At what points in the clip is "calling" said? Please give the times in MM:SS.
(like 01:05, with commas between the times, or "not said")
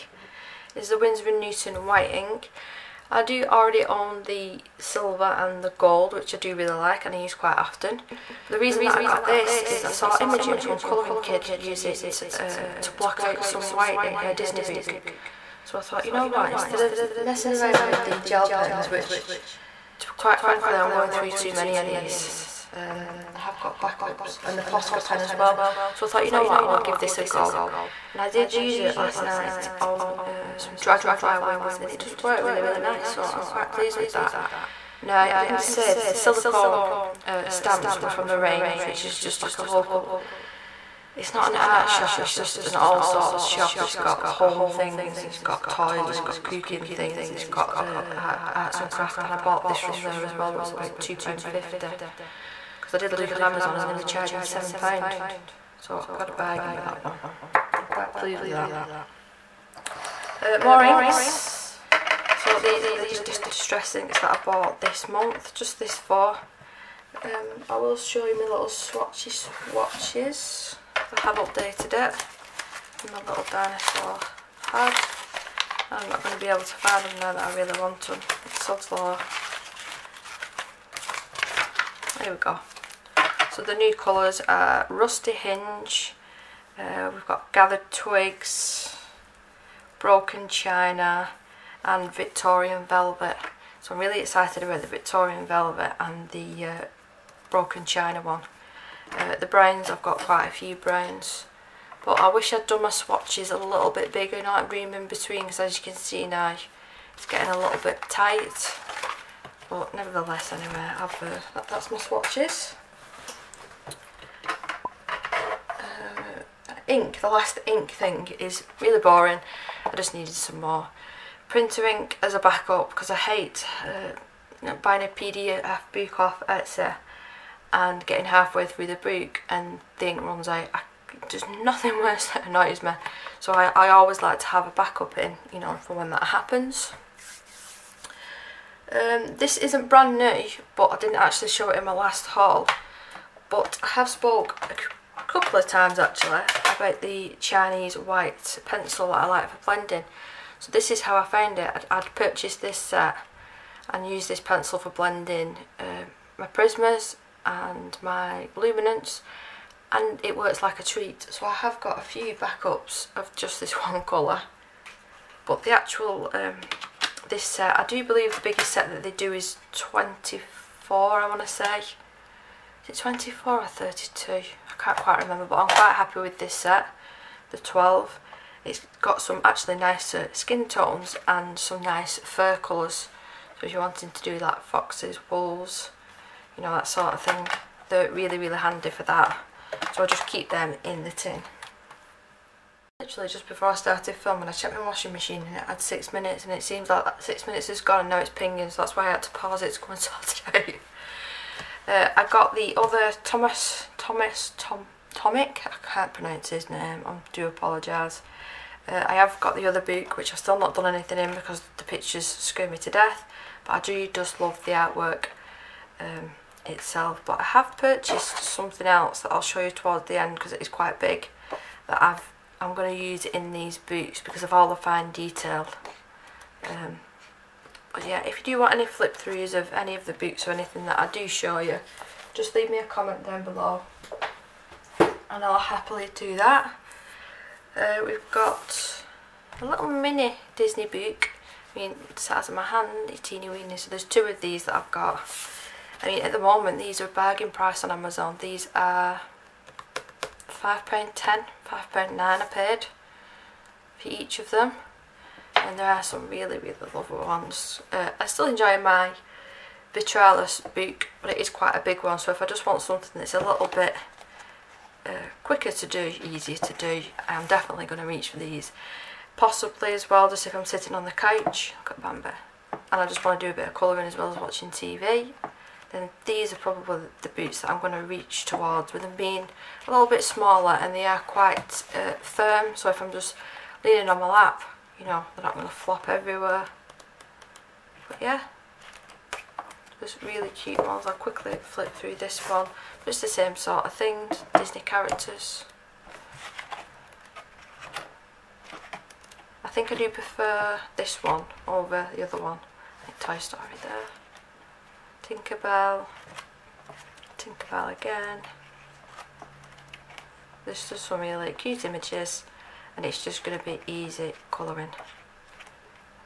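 not said.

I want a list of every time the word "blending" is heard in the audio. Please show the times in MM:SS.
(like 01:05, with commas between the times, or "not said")
02:29, 02:34.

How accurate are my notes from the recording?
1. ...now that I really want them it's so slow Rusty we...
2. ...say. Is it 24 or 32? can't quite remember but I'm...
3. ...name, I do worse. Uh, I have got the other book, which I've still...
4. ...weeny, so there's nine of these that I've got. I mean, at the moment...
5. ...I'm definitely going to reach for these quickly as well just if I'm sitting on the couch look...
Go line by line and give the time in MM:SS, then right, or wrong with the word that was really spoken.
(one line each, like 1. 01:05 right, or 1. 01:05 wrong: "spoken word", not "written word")
1. 01:17 wrong: "There", not "Rusty"
2. 02:51 right
3. 03:26 wrong: "apologise", not "worse"
4. 04:03 wrong: "two", not "nine"
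5. 04:27 wrong: "possibly", not "quickly".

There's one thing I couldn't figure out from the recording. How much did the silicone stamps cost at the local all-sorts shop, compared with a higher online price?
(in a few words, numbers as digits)
£2.50.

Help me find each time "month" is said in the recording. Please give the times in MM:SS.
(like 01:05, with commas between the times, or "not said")
01:05.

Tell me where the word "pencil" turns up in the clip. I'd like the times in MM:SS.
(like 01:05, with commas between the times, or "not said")
02:28, 02:34.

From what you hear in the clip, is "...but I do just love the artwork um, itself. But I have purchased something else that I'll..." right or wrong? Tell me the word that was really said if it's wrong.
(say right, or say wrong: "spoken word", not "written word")
right.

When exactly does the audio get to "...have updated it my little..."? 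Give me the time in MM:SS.
01:11.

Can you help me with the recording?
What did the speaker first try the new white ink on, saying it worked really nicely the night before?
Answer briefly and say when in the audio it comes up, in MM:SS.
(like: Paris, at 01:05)
dragonfly wings, at 00:30.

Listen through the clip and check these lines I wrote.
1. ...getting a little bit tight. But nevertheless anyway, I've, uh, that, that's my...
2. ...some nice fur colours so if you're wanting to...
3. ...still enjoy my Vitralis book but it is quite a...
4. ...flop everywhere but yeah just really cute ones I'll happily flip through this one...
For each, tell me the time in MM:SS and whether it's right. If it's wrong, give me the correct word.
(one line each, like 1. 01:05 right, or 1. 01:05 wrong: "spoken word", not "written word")
1. 01:47 right
2. 03:01 right
3. 04:18 right
4. 04:45 wrong: "quickly", not "happily".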